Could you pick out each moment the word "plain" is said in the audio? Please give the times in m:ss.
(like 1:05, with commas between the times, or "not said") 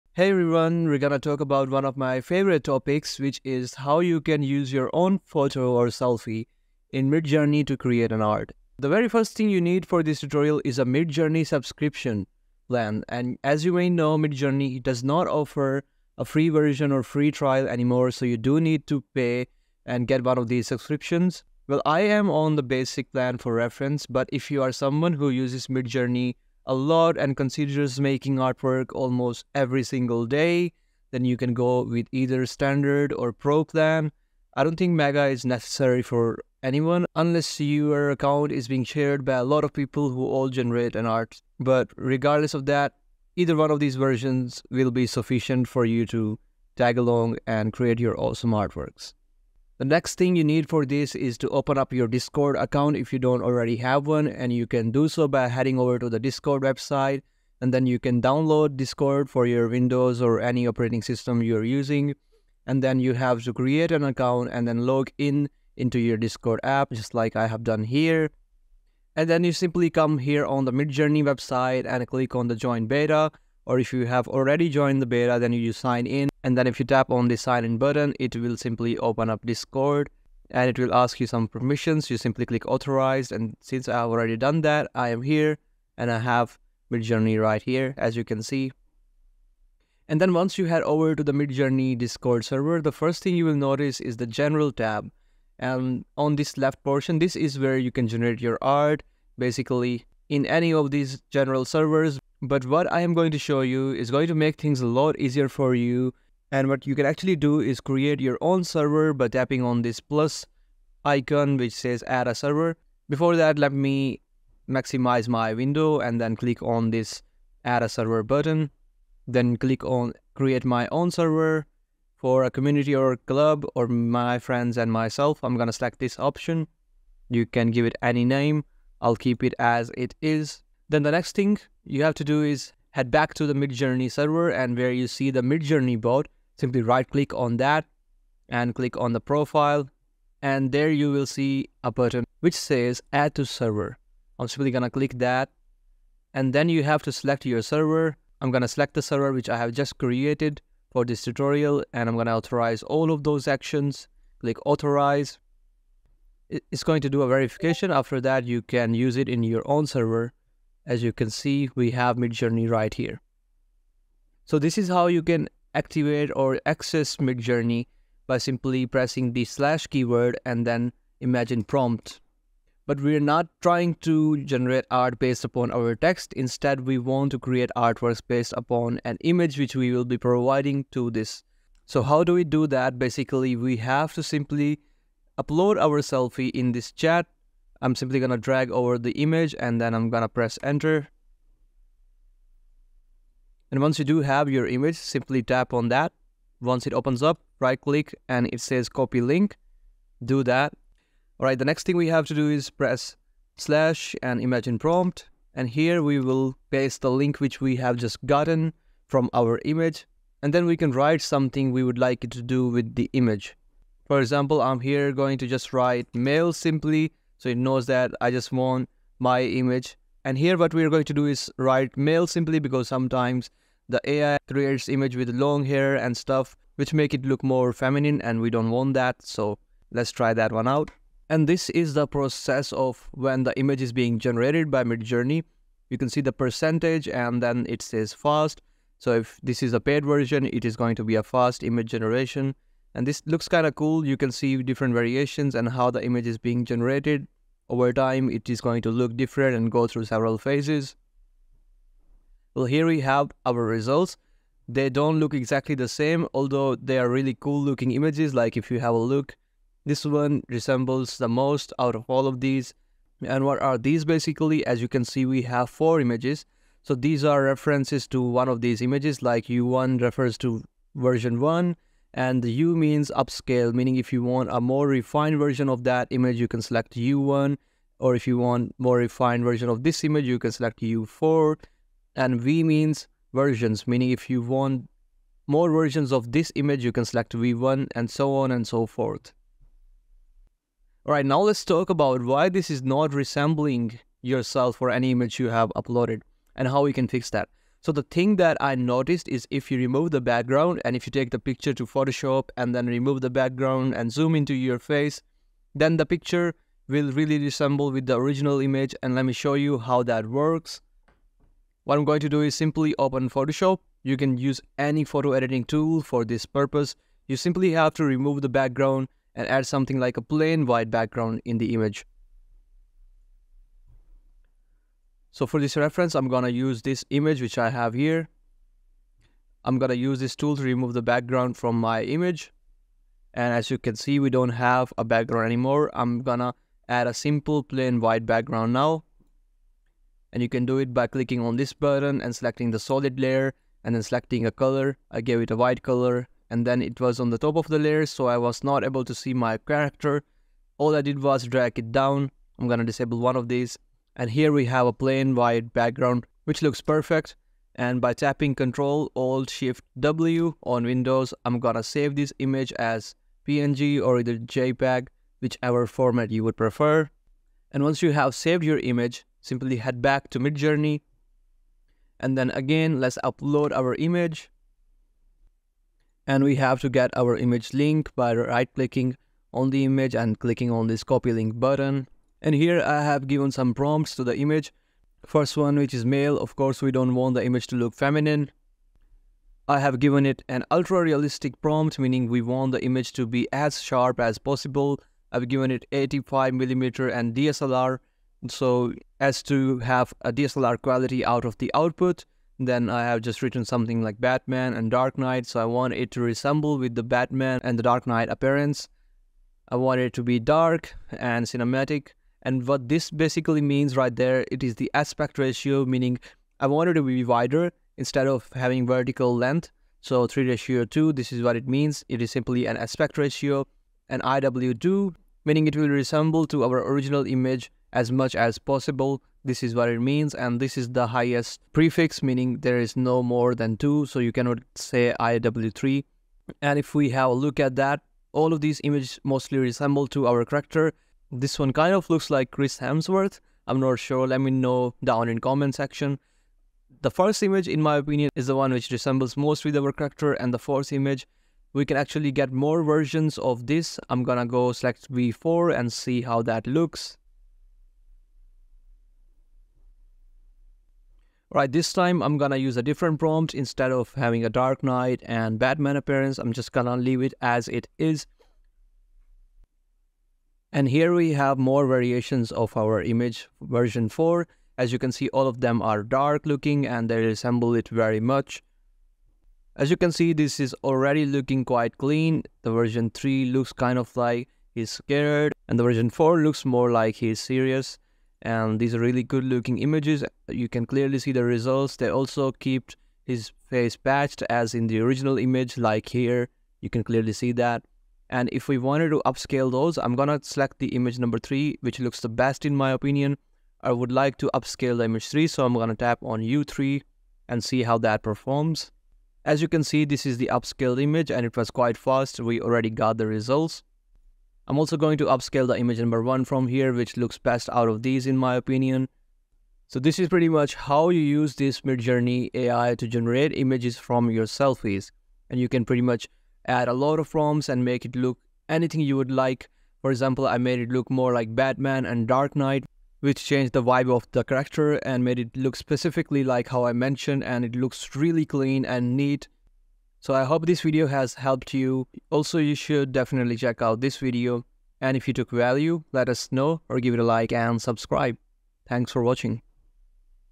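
5:20, 5:37, 5:54.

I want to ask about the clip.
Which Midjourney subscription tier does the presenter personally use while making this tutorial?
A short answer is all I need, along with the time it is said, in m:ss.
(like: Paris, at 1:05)
Basic plan, at 0:22.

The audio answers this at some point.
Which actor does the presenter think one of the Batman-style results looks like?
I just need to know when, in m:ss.
7:22.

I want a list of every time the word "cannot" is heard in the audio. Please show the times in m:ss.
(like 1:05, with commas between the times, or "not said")
7:14.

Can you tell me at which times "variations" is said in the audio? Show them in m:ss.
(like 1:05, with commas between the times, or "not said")
4:04, 7:51.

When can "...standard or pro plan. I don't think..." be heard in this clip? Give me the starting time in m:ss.
0:32.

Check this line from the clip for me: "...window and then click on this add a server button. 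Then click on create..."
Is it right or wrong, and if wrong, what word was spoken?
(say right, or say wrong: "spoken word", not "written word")
right.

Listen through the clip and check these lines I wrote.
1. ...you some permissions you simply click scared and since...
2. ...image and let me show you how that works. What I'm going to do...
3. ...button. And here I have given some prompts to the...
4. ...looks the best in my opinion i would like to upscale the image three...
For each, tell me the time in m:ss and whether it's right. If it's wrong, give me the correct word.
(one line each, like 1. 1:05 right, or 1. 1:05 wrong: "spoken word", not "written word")
1. 1:21 wrong: "authorized", not "scared"
2. 5:08 right
3. 6:21 right
4. 8:21 right.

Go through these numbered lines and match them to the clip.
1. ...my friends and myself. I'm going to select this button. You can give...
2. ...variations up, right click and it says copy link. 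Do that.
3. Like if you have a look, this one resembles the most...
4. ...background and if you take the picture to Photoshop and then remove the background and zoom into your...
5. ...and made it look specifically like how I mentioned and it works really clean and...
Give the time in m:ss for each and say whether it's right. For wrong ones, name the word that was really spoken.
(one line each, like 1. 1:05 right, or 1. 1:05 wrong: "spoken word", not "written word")
1. 2:03 wrong: "option", not "button"
2. 3:16 wrong: "opens", not "variations"
3. 4:18 right
4. 5:00 right
5. 8:55 wrong: "looks", not "works".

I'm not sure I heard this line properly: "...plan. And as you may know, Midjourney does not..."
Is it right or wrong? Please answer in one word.
right.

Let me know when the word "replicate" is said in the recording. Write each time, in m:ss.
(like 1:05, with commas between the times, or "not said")
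not said.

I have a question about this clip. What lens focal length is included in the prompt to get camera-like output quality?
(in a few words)
85mm.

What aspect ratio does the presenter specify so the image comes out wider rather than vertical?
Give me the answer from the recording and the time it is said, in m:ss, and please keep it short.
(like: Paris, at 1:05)
3:2, at 7:00.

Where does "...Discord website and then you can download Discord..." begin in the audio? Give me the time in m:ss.
0:56.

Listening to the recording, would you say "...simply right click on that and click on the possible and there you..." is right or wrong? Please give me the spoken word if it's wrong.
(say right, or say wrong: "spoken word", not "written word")
wrong: "profile", not "possible".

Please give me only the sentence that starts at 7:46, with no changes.
I'm just gonna leave it as it is.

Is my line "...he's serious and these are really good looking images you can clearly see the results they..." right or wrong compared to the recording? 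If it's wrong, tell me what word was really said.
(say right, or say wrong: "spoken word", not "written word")
right.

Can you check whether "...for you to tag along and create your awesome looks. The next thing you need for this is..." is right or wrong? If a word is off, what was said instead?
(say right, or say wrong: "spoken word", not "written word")
wrong: "artworks", not "looks".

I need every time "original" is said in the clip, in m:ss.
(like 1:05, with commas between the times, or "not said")
5:08, 7:06, 8:14.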